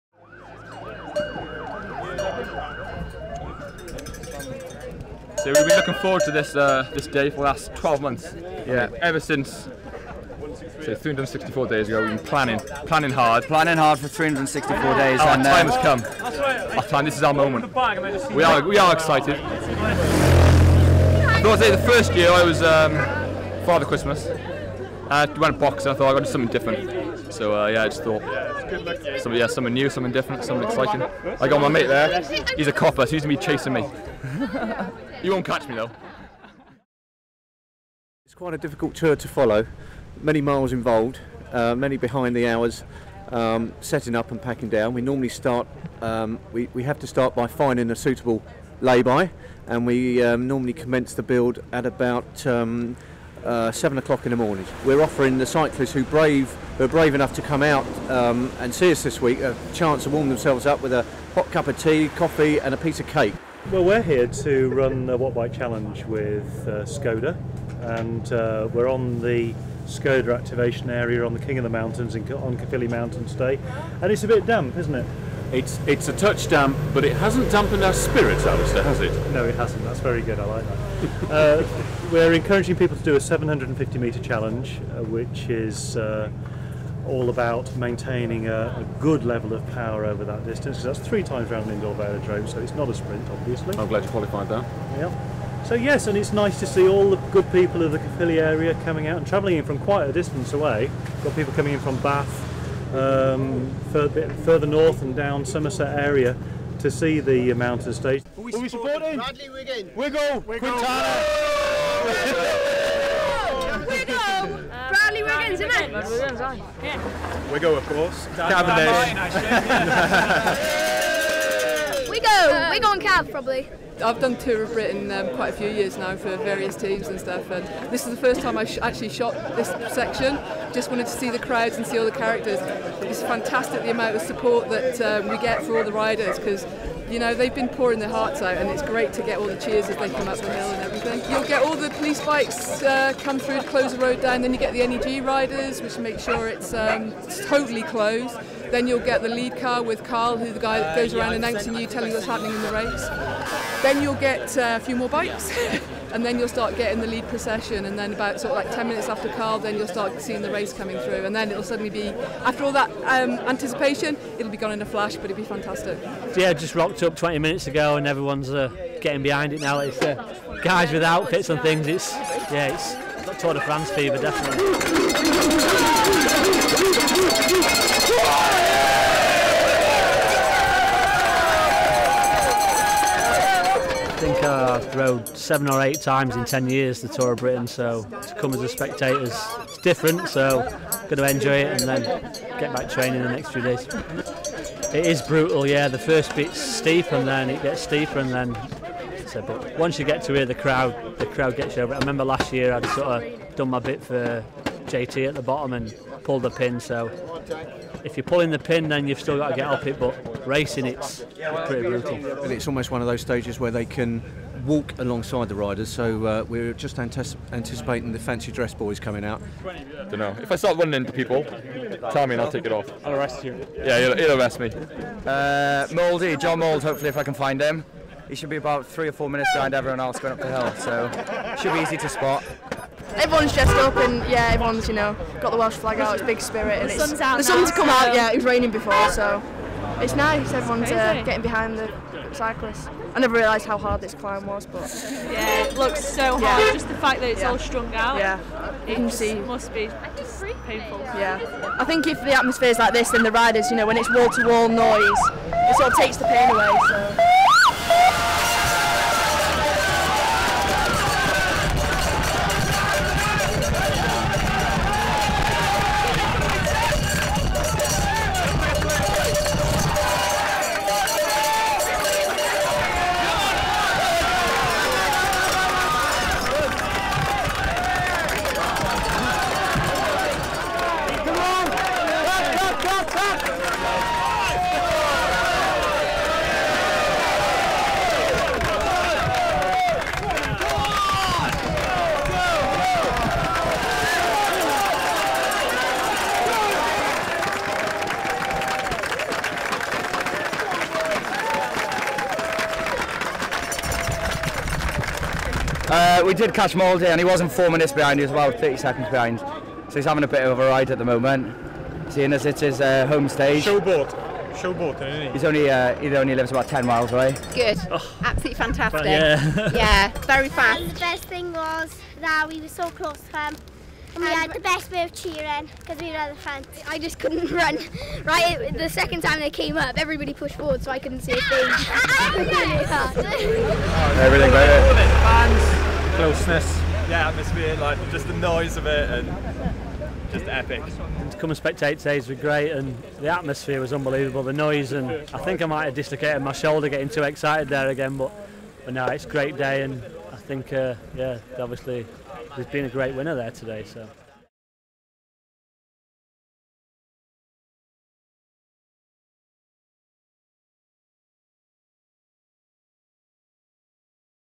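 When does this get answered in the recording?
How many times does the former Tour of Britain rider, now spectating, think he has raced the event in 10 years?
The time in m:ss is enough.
3:05.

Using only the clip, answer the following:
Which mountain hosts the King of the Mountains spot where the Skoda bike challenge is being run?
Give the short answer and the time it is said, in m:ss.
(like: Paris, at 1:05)
Caerphilly Mountain, at 1:12.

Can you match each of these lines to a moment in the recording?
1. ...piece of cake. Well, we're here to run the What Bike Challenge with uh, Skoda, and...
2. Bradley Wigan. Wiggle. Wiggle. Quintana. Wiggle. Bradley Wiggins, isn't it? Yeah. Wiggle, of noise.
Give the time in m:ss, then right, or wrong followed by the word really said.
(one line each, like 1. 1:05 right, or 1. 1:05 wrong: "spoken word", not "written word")
1. 1:02 right
2. 1:49 wrong: "course", not "noise".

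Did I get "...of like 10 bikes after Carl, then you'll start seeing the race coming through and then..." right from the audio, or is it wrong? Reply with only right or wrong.
wrong.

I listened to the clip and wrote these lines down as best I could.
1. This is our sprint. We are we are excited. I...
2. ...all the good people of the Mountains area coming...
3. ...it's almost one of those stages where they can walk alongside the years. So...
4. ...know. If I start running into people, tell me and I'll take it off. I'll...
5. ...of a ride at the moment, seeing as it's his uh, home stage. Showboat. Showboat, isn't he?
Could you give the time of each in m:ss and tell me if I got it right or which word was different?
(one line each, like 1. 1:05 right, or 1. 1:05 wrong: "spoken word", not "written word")
1. 0:17 wrong: "moment", not "sprint"
2. 1:36 wrong: "Caerphilly", not "Mountains"
3. 3:32 wrong: "riders", not "years"
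4. 3:40 right
5. 5:10 right.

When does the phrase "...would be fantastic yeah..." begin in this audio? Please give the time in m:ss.
2:45.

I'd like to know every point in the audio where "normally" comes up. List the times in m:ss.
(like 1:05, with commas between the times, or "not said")
0:45, 0:50.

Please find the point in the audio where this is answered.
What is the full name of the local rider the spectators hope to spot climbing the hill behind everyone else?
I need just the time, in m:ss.
3:46.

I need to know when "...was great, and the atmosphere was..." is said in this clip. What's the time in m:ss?
5:42.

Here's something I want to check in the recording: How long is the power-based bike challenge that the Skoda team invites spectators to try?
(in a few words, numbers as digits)
750 metres.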